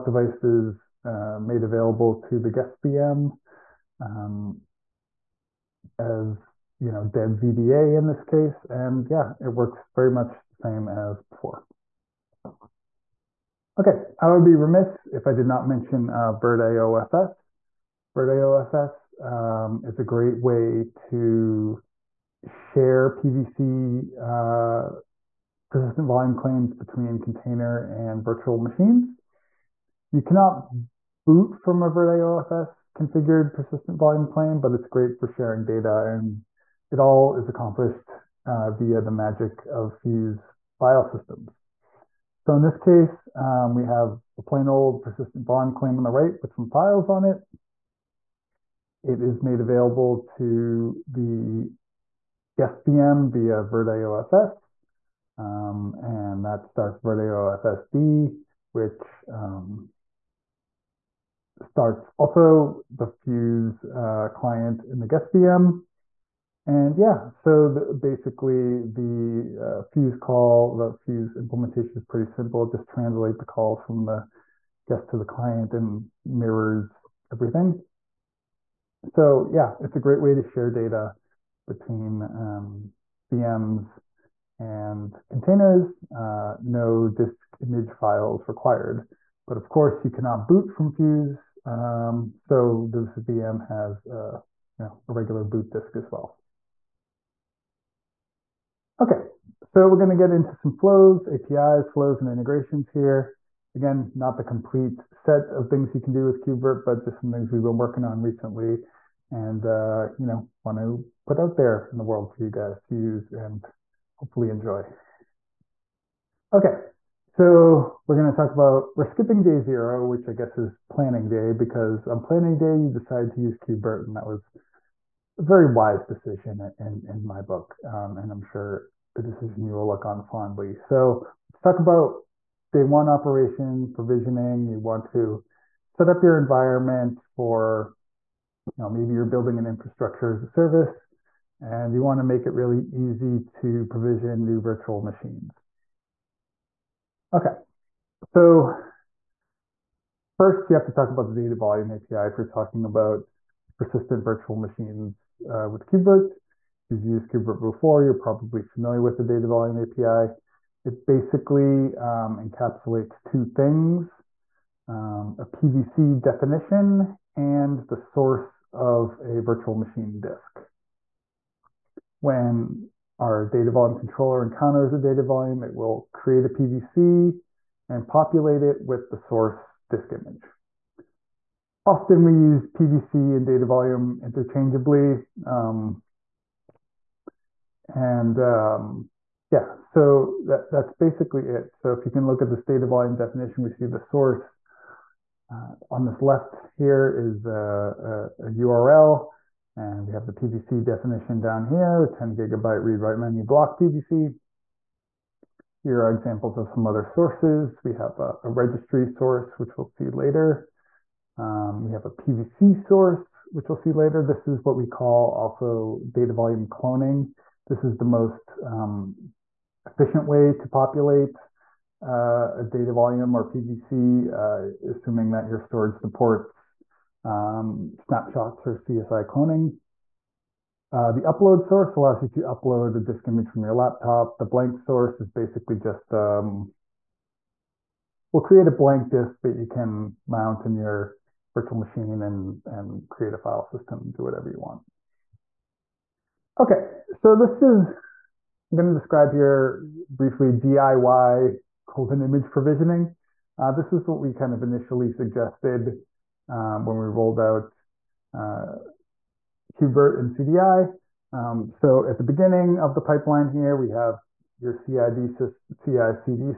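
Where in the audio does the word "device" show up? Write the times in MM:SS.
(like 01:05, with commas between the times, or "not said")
00:00.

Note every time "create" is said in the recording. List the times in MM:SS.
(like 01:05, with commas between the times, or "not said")
02:56, 03:58, 04:03.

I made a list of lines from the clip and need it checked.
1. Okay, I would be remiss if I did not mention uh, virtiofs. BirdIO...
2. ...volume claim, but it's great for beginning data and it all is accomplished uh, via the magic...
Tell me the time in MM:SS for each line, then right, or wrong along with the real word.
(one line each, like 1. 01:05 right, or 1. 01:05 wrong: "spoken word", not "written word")
1. 00:13 right
2. 00:33 wrong: "sharing", not "beginning".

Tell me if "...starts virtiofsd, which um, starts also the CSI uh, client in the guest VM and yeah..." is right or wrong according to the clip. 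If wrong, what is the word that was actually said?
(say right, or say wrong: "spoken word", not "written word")
wrong: "Fuse", not "CSI".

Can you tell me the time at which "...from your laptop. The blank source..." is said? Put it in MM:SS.
03:53.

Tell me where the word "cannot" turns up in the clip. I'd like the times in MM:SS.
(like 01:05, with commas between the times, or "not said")
00:30, 01:30.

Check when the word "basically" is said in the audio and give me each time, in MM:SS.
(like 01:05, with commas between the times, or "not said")
01:07, 02:41, 03:10, 03:55.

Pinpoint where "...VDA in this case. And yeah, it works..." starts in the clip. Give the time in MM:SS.
00:07.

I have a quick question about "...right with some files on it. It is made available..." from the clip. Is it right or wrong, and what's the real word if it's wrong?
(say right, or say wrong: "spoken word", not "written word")
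right.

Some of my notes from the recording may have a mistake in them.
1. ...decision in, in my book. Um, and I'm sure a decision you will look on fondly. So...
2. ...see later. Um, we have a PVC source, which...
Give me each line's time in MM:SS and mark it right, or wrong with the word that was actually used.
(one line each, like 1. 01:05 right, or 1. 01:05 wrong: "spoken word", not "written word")
1. 02:06 right
2. 03:29 right.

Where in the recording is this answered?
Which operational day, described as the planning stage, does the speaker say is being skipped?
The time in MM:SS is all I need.
01:59.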